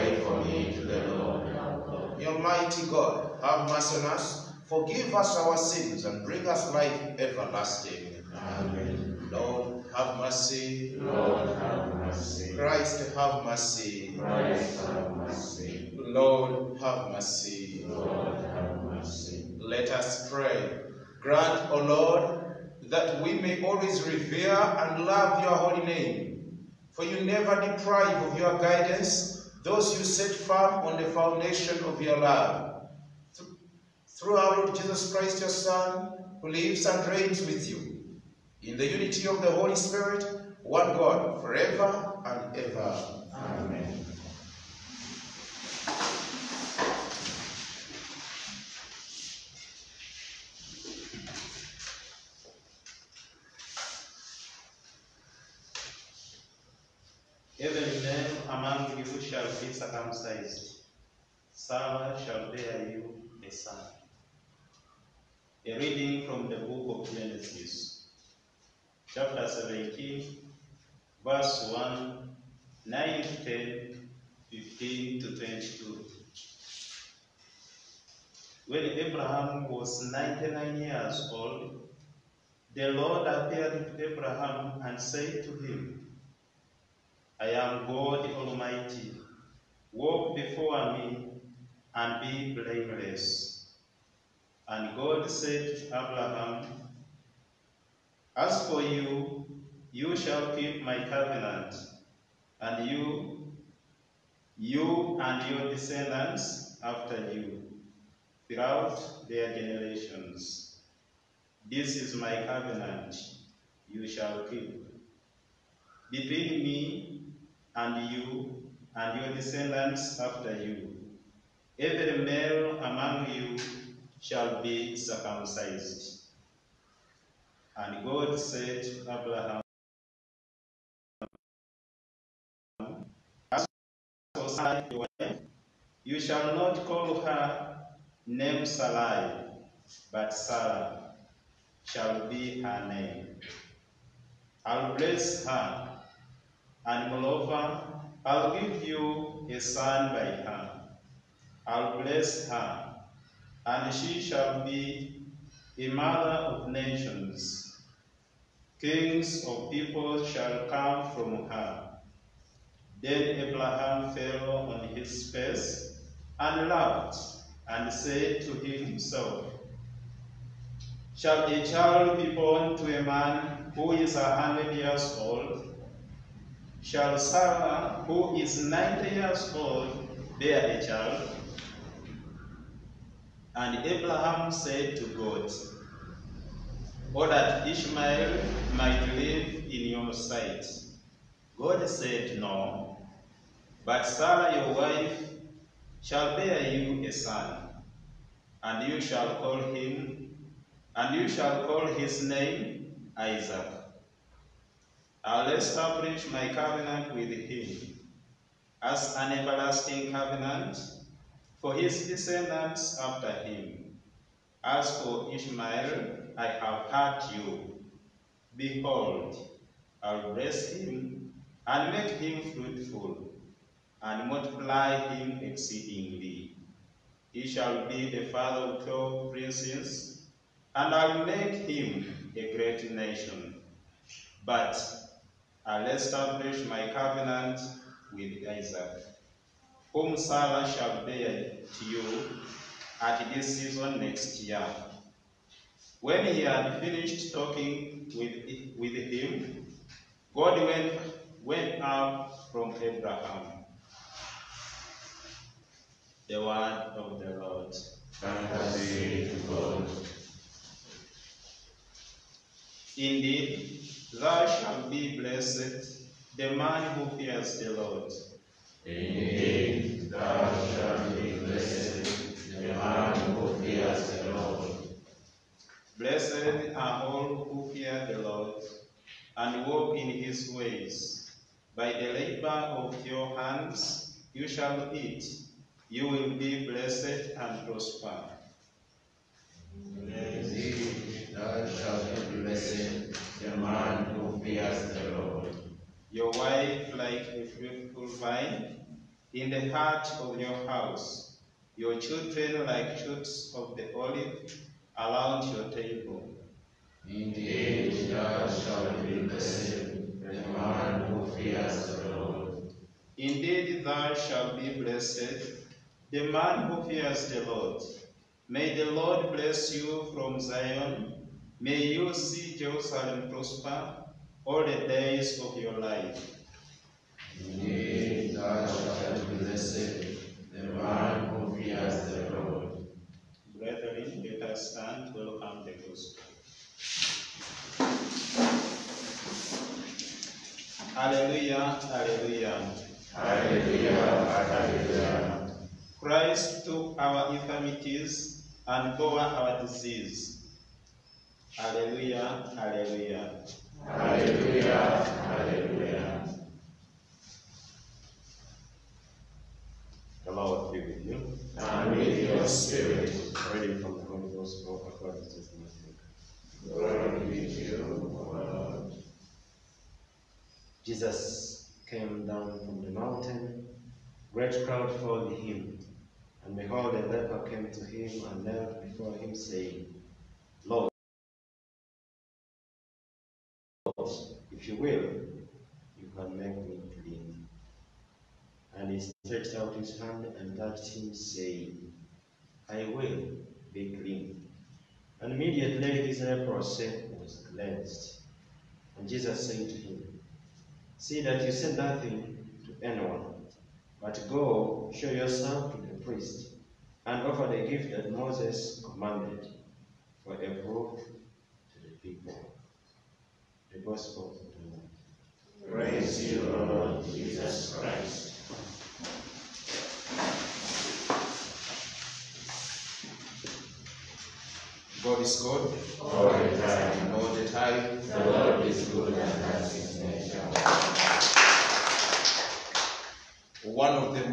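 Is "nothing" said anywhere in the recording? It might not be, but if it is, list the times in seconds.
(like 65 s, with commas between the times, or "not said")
401 s.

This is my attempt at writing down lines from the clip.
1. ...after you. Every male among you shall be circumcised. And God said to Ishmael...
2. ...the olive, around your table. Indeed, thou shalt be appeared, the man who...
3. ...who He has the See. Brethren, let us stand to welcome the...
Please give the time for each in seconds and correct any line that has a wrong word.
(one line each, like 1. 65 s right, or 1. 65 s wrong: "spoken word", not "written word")
1. 120 s wrong: "Abraham", not "Ishmael"
2. 303 s wrong: "blessed", not "appeared"
3. 331 s wrong: "Lord", not "See".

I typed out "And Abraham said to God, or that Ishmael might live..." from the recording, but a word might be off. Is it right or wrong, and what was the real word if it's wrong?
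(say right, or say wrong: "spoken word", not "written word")
right.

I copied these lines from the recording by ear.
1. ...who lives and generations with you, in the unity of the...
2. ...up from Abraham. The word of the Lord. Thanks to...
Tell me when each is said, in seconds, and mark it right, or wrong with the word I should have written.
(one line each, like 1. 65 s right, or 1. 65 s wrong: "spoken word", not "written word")
1. 36 s wrong: "reigns", not "generations"
2. 251 s right.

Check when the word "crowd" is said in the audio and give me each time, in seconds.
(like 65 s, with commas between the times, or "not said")
374 s.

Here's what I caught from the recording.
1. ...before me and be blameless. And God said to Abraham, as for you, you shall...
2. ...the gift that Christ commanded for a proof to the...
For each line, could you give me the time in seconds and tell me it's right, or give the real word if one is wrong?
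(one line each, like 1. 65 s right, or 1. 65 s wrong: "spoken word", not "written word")
1. 90 s right
2. 407 s wrong: "Moses", not "Christ".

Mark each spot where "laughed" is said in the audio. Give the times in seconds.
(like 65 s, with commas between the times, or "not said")
166 s.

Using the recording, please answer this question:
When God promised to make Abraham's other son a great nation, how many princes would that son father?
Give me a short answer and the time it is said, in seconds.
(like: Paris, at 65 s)
12, at 228 s.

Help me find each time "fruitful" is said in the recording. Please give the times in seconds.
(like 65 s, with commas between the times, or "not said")
222 s, 297 s.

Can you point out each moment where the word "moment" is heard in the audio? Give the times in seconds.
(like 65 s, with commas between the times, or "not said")
not said.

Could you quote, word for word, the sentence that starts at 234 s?
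But I'll establish my covenant with Isaac, whom Sarah shall bear to you at this season next year.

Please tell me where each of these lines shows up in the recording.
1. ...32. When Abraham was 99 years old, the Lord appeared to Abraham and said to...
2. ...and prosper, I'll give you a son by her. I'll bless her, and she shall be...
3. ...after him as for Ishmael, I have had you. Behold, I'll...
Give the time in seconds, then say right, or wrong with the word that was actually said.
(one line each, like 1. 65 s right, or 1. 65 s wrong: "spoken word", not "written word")
1. 75 s wrong: "22", not "32"
2. 146 s wrong: "moreover", not "prosper"
3. 212 s right.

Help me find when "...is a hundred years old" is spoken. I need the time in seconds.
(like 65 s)
173 s.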